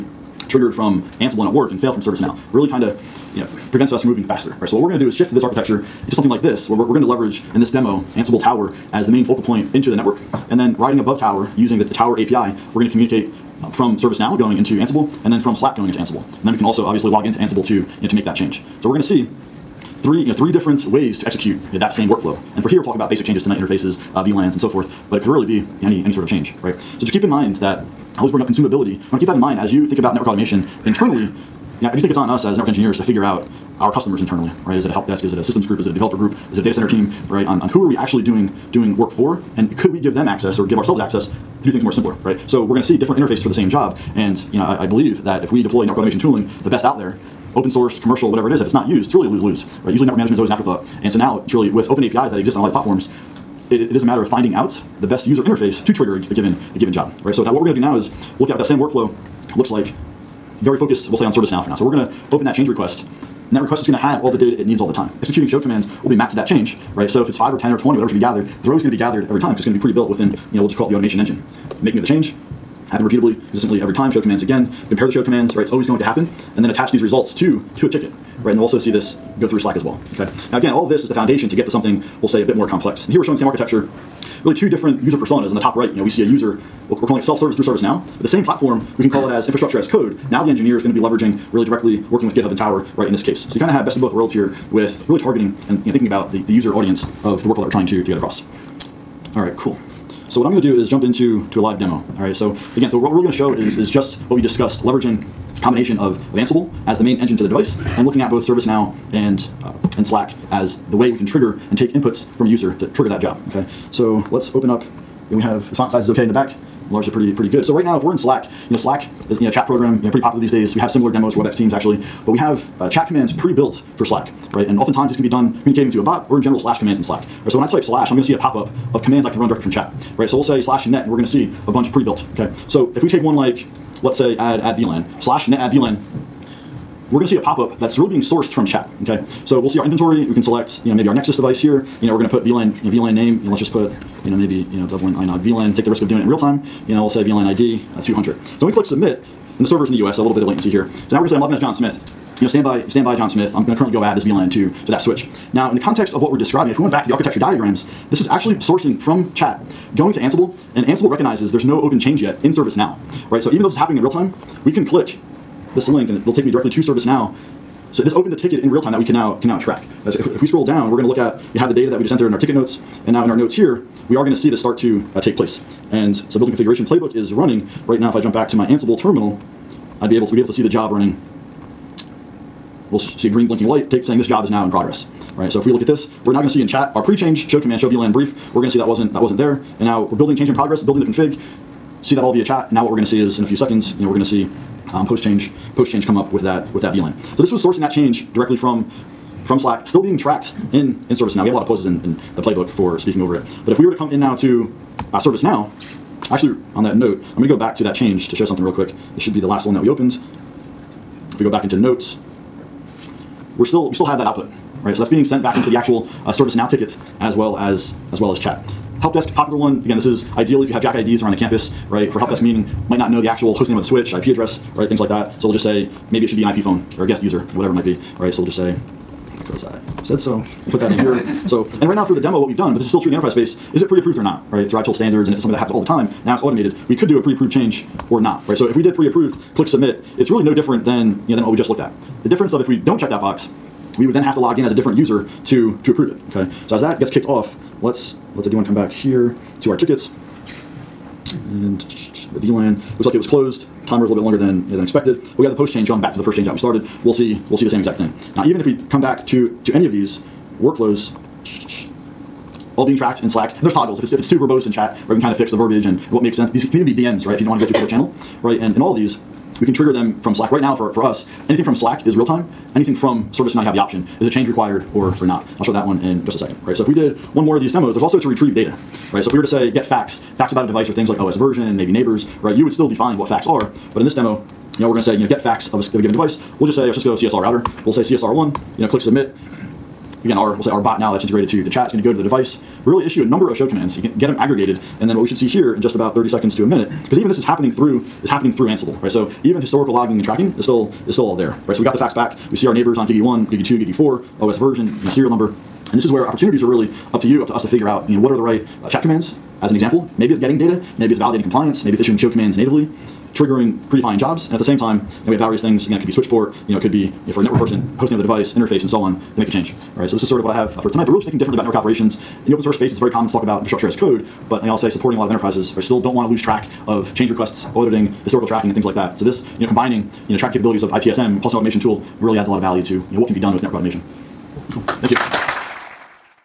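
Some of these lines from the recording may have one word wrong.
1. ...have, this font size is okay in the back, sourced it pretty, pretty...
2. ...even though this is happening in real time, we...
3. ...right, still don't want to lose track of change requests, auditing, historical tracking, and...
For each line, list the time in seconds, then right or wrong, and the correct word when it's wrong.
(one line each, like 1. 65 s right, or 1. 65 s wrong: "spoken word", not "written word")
1. 115 s wrong: "enlarged", not "sourced"
2. 163 s right
3. 325 s right.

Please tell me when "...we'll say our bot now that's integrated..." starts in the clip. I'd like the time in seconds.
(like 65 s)
290 s.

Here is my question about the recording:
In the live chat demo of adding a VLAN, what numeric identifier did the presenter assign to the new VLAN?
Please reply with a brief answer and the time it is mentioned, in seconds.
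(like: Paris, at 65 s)
200, at 148 s.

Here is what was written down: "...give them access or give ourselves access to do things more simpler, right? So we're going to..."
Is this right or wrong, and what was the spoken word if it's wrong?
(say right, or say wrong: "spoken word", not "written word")
right.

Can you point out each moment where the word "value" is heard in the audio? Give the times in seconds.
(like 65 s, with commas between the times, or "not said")
332 s.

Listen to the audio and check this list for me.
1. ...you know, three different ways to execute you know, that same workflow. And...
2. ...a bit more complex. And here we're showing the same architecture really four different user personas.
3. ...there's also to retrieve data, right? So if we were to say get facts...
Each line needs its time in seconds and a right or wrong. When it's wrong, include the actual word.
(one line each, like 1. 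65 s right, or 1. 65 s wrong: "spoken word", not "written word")
1. 20 s right
2. 82 s wrong: "two", not "four"
3. 277 s right.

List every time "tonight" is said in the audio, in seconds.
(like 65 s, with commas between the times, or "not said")
23 s, 320 s.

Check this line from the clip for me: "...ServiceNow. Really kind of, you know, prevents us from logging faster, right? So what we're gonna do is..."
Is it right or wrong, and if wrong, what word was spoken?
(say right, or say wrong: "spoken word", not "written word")
wrong: "moving", not "logging".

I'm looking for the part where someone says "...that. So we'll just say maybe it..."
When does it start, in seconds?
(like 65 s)
225 s.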